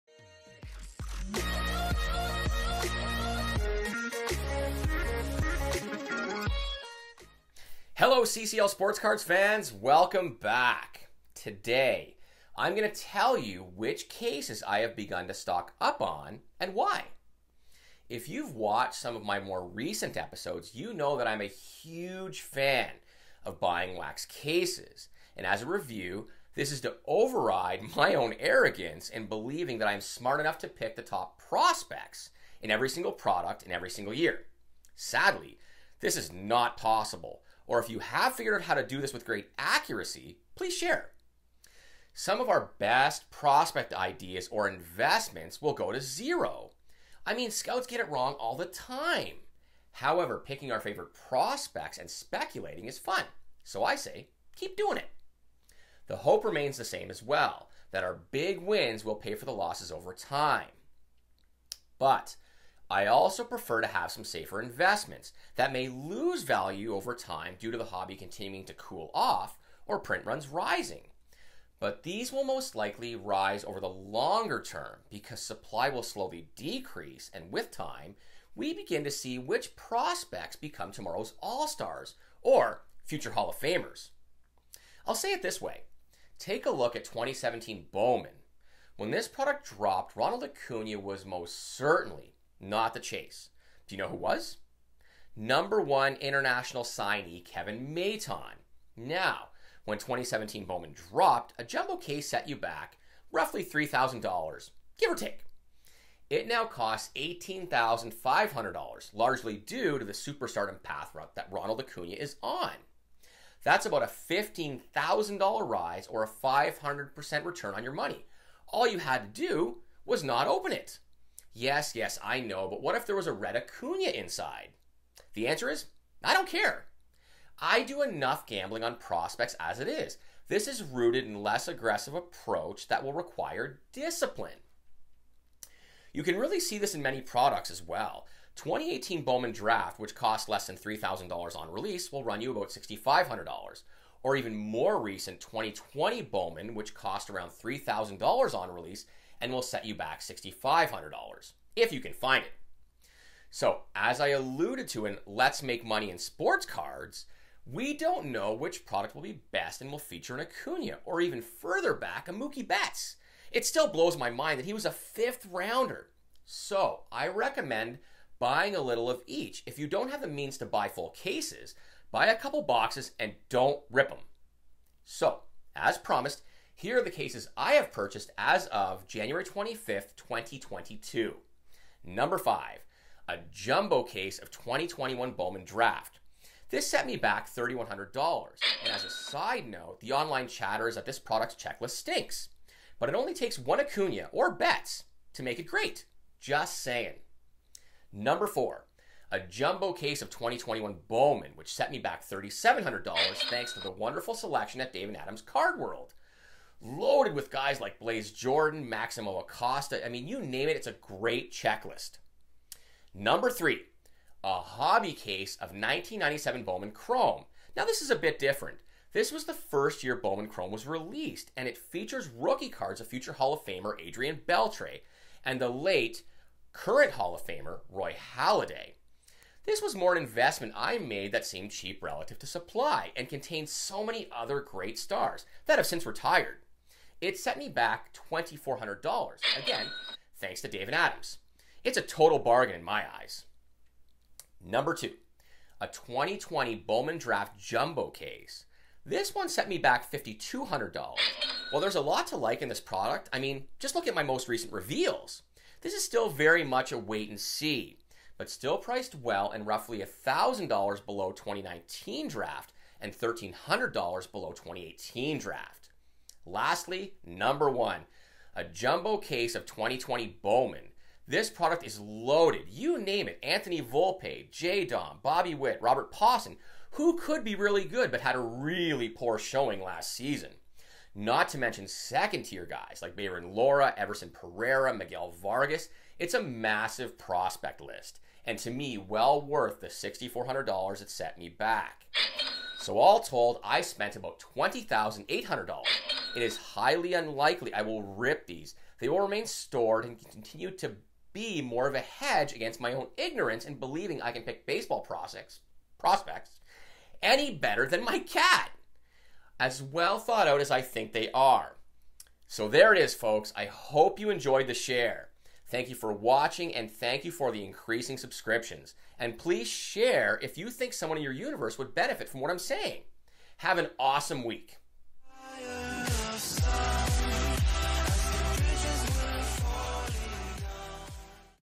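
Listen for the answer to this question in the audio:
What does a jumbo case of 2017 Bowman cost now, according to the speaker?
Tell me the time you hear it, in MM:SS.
01:47.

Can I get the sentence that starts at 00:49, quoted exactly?
However, picking our favorite prospects and speculating is fun.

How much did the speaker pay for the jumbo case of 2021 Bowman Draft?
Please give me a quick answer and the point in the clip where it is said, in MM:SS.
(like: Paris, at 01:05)
$3,100, at 03:07.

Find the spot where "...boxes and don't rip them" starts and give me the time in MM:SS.
02:52.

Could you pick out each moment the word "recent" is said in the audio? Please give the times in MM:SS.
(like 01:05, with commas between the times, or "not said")
00:19, 02:25, 04:14.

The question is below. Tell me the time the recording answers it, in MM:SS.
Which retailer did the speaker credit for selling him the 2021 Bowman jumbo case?
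03:24.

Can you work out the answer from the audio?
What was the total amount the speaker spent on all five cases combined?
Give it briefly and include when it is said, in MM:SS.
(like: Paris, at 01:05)
$20,800, at 04:54.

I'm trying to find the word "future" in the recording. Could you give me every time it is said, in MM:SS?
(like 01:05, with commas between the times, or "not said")
01:23, 03:43.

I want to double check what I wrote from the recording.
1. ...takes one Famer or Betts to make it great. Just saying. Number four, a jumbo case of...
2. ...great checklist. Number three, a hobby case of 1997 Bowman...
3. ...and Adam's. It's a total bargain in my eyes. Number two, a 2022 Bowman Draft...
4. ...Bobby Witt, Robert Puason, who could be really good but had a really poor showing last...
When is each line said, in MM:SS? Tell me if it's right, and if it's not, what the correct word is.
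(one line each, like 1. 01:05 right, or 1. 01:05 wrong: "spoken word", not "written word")
1. 03:13 wrong: "Acuna", not "Famer"
2. 03:30 right
3. 04:00 wrong: "2020", not "2022"
4. 04:35 right.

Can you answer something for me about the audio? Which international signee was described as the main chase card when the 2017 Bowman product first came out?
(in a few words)
Kevin Maitan.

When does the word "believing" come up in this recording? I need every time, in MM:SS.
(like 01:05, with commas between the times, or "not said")
00:29, 05:03.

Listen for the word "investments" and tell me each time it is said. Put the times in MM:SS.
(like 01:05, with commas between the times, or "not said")
00:44, 01:04, 03:50.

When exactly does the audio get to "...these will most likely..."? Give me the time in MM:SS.
01:12.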